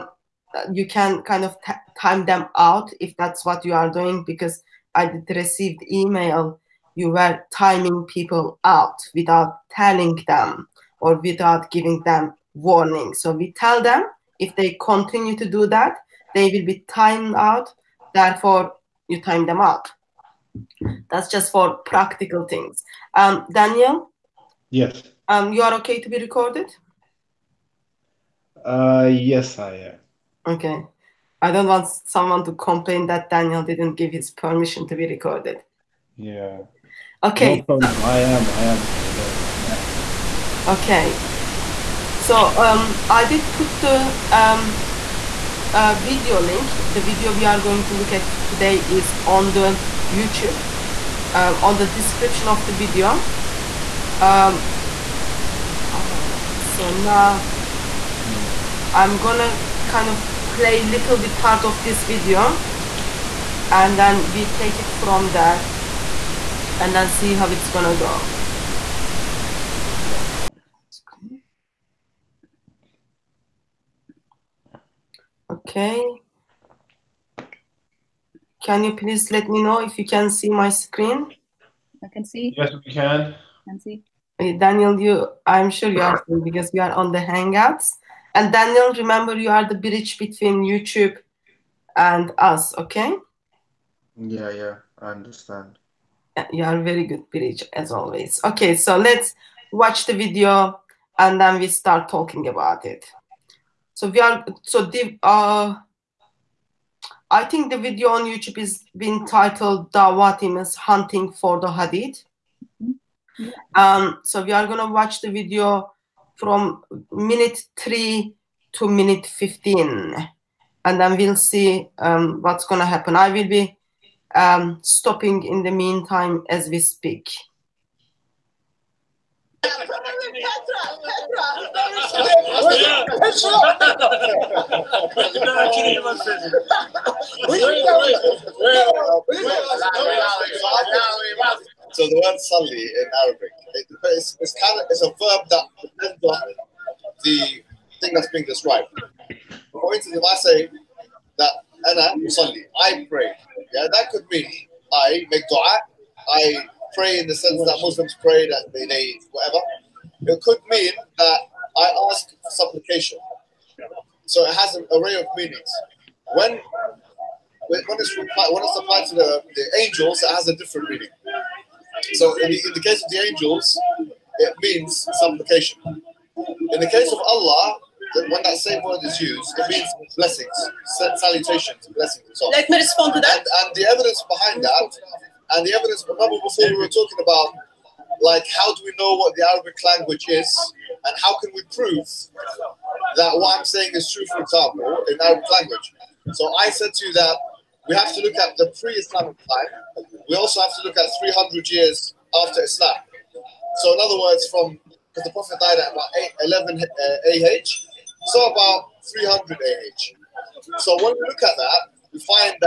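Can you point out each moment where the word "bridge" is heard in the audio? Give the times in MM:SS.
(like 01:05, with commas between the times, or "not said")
01:29, 01:37.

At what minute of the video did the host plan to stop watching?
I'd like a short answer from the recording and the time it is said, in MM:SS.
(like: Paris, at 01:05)
15, at 01:58.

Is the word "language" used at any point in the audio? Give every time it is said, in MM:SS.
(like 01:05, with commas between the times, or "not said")
03:09, 03:15.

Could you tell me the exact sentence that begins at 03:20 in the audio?
We also have to look at 300 years after Islam.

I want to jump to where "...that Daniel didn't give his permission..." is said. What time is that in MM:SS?
00:33.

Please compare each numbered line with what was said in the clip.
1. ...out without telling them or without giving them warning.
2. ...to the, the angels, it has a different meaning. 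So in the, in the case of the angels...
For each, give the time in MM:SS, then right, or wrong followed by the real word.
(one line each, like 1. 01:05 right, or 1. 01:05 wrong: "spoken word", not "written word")
1. 00:08 right
2. 02:49 right.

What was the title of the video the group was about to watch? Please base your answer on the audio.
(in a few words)
Dawat is Hunting for the Hadith.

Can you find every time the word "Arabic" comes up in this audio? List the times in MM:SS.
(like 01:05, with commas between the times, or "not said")
02:23, 03:09, 03:15.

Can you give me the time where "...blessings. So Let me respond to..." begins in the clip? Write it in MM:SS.
03:01.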